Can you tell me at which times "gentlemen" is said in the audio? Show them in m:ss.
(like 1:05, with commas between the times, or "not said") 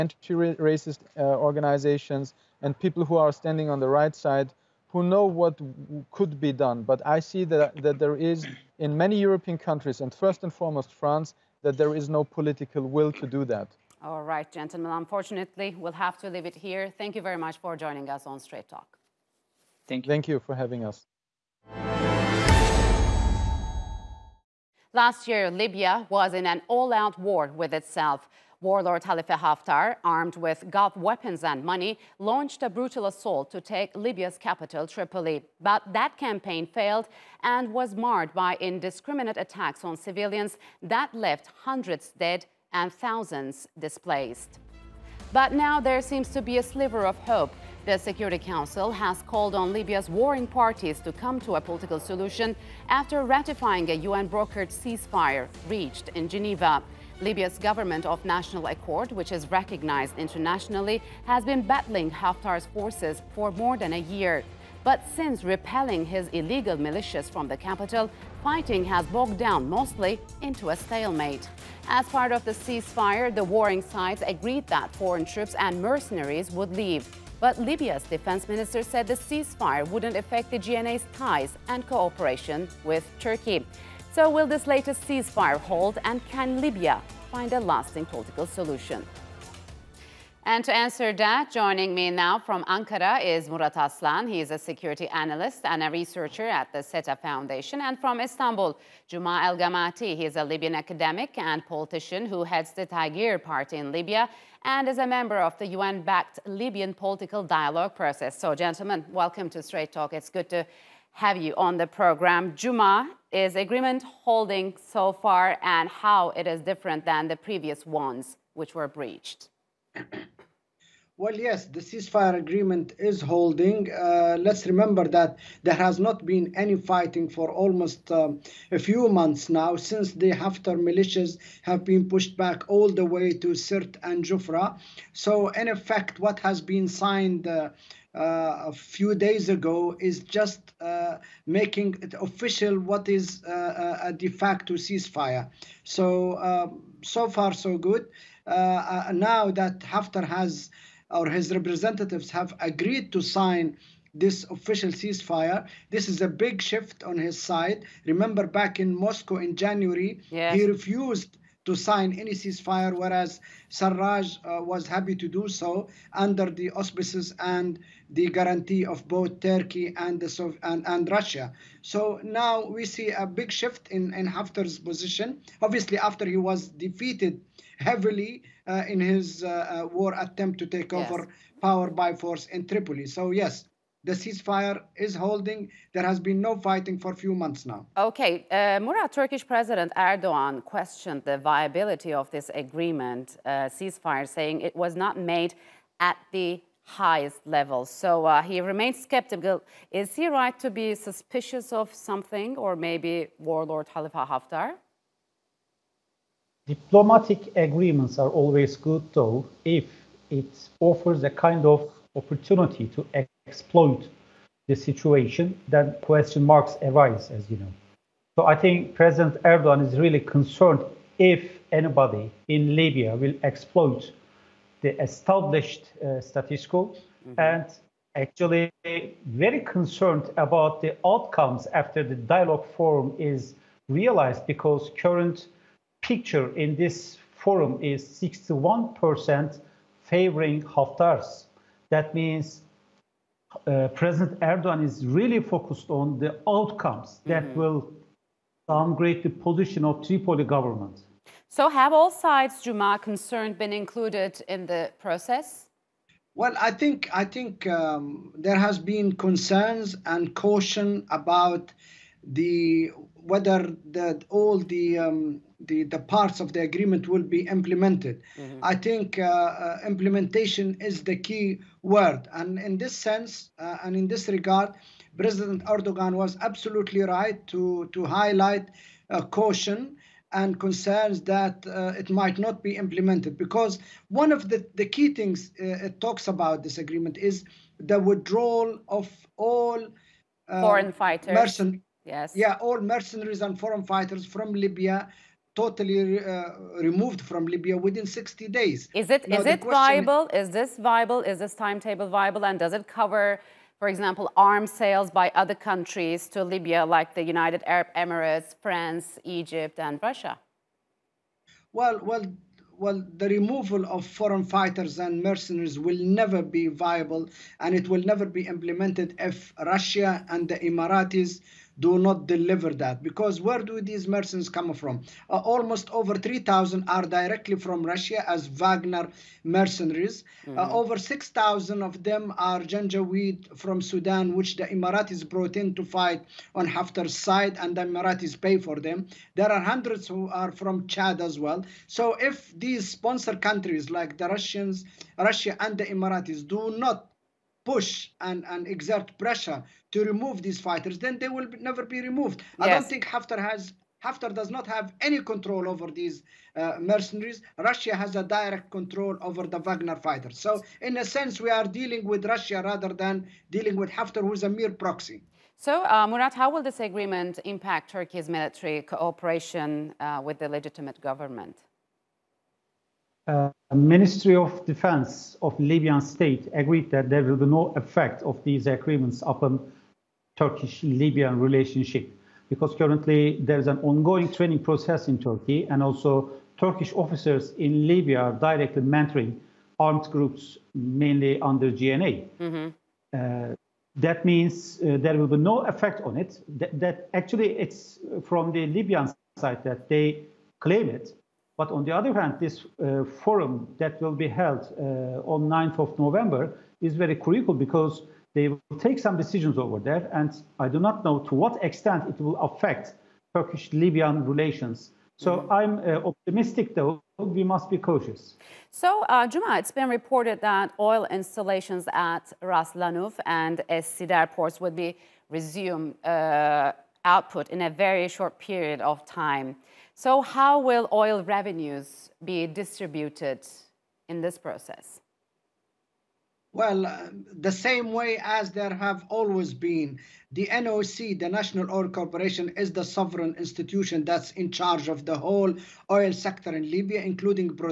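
0:14, 1:48.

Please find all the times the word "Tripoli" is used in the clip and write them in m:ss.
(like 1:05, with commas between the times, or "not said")
0:34, 3:02, 4:10.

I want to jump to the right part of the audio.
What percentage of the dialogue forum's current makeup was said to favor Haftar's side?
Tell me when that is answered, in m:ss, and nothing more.
3:58.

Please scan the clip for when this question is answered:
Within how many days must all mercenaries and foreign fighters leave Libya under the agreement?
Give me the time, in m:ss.
4:58.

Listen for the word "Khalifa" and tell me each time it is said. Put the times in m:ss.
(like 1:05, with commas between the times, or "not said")
0:29, 3:23.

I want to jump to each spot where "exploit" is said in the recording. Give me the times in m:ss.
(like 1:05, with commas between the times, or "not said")
3:33, 3:43.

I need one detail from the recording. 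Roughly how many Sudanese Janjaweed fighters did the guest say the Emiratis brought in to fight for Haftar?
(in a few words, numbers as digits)
over 6,000.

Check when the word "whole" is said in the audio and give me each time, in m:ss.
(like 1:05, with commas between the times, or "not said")
7:25.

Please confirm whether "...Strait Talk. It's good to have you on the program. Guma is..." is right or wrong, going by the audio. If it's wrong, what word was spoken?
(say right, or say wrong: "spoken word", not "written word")
right.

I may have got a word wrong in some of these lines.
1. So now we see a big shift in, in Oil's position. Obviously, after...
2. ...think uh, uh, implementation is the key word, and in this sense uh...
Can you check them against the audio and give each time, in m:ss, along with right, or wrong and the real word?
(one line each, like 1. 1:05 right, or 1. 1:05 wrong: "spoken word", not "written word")
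1. 2:51 wrong: "Haftar", not "Oil"
2. 4:28 right.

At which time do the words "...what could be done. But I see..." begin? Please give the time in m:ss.
0:05.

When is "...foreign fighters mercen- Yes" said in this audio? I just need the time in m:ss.
4:50.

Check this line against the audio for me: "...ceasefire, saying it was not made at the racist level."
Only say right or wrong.
wrong.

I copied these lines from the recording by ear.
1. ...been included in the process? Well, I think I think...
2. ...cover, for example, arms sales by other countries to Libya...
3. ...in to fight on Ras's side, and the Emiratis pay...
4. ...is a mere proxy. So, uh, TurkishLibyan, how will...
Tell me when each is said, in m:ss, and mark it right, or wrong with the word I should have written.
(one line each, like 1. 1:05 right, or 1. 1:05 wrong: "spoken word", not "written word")
1. 4:13 right
2. 5:02 right
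3. 5:35 wrong: "Haftar", not "Ras"
4. 6:04 wrong: "Murat", not "TurkishLibyan".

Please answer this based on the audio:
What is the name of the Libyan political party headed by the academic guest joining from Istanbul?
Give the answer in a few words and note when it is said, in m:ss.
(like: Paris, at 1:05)
Taghyeer Party, at 1:42.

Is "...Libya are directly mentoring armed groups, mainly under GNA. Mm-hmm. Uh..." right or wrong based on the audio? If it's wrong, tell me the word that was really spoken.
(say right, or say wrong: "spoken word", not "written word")
right.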